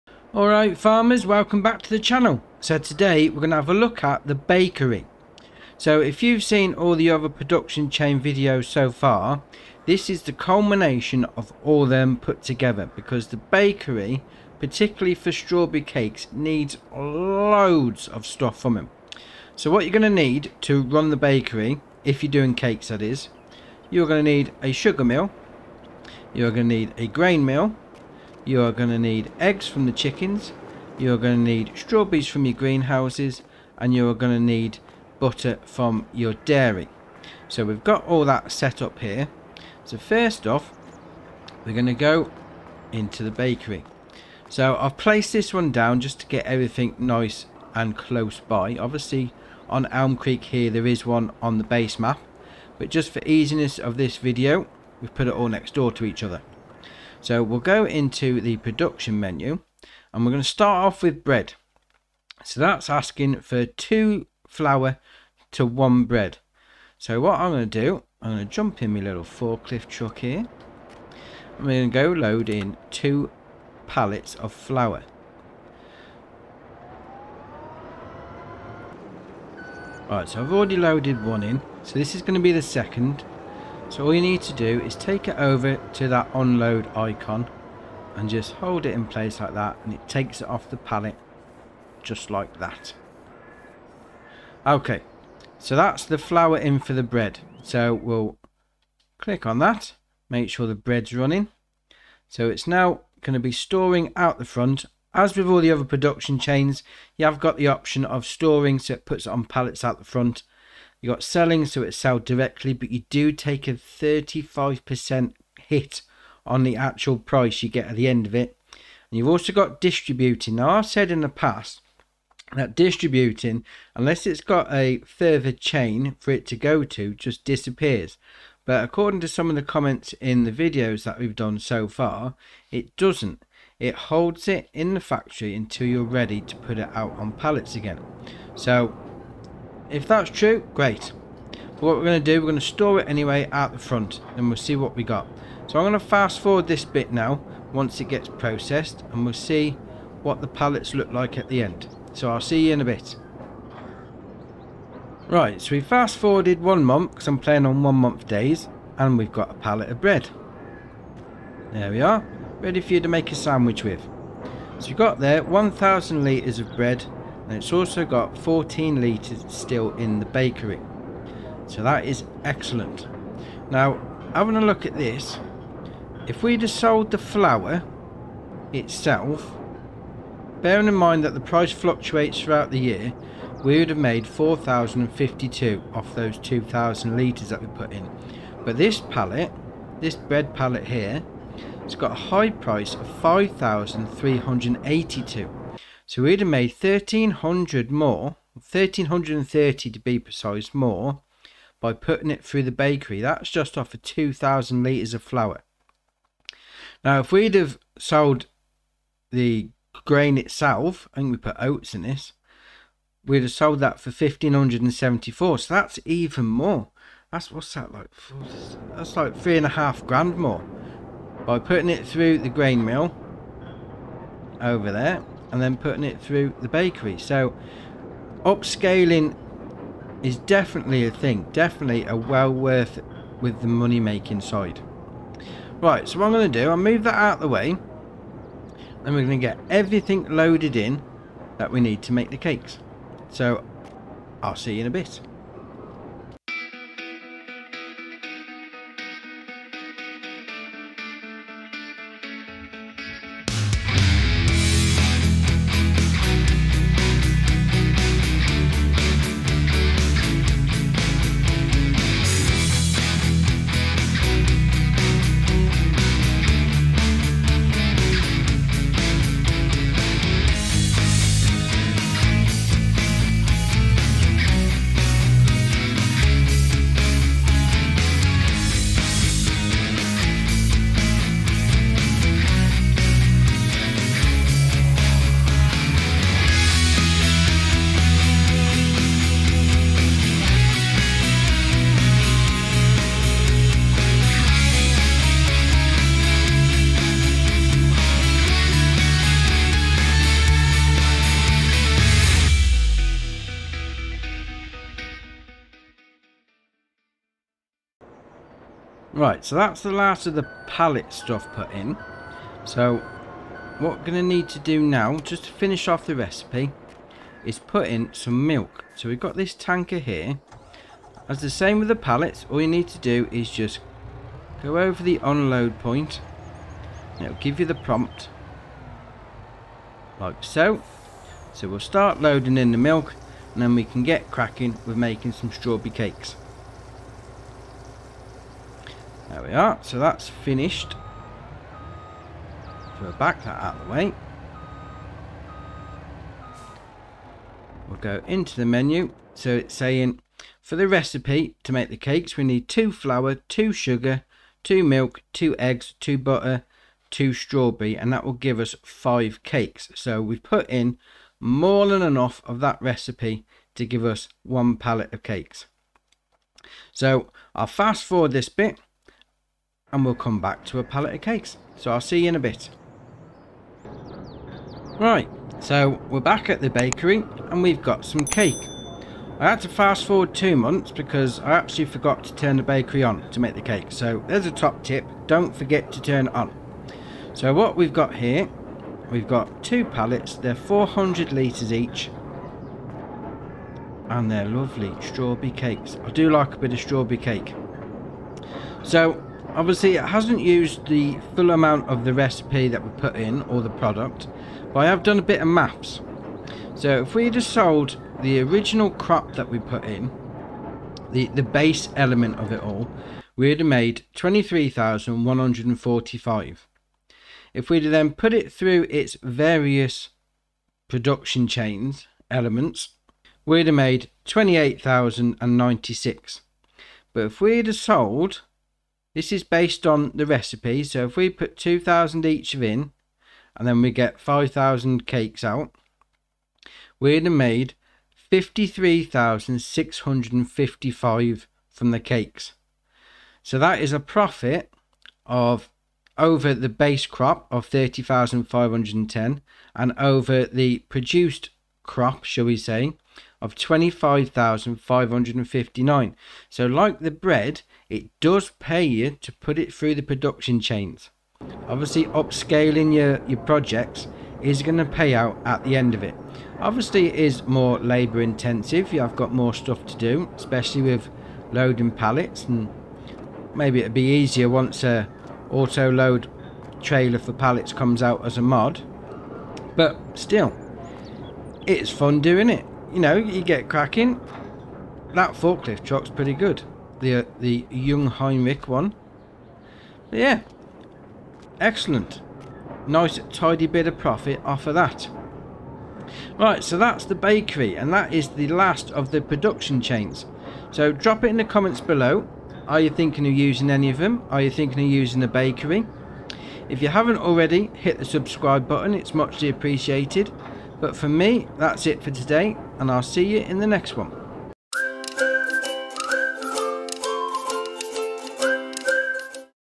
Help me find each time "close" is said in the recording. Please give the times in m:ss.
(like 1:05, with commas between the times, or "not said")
0:47.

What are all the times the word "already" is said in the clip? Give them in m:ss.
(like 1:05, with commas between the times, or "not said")
1:20, 8:27.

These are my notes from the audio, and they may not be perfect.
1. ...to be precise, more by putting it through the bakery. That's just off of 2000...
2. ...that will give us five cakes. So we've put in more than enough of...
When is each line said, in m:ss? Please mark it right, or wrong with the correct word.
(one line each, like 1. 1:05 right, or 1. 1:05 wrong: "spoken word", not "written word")
1. 3:19 right
2. 5:58 right.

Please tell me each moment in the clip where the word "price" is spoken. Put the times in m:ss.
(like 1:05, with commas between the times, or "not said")
1:57, 3:01, 3:12.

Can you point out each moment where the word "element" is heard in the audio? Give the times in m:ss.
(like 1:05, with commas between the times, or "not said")
6:51, 7:02.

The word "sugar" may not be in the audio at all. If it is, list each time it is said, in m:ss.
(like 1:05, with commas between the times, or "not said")
0:24, 5:53.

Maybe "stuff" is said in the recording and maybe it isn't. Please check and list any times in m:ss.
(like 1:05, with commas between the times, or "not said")
0:18, 5:11, 7:49.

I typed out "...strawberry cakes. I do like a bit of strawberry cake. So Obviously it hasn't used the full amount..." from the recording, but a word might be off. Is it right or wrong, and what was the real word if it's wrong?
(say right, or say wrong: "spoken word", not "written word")
right.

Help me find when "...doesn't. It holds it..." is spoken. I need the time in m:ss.
2:12.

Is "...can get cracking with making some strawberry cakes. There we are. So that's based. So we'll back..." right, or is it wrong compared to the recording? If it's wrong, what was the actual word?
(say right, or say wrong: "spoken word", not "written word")
wrong: "finished", not "based".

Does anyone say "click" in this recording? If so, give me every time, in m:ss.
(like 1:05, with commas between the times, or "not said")
1:39.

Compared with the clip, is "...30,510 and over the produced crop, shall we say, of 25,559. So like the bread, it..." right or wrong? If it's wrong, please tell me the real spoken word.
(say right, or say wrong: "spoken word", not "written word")
right.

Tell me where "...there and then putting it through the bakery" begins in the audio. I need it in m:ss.
3:44.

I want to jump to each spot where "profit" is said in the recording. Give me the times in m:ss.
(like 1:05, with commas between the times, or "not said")
7:23, 8:13.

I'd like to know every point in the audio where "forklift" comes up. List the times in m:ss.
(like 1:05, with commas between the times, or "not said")
1:09, 8:05.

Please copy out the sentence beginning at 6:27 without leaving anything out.
So what we've got here, we've got two pallets, they're 400 litres each.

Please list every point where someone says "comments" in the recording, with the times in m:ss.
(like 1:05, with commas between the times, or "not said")
2:09, 8:21.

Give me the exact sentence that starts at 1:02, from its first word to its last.
So that's asking for two flour to one bread.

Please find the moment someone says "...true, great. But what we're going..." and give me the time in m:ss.
2:20.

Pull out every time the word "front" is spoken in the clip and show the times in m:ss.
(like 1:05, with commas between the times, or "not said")
1:44, 1:50, 2:23.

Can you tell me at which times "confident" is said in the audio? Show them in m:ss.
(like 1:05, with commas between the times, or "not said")
not said.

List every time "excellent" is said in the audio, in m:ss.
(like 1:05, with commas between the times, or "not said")
2:52, 8:11.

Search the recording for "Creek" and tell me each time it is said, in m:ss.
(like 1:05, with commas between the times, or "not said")
0:50.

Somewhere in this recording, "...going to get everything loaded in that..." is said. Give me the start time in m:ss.
3:59.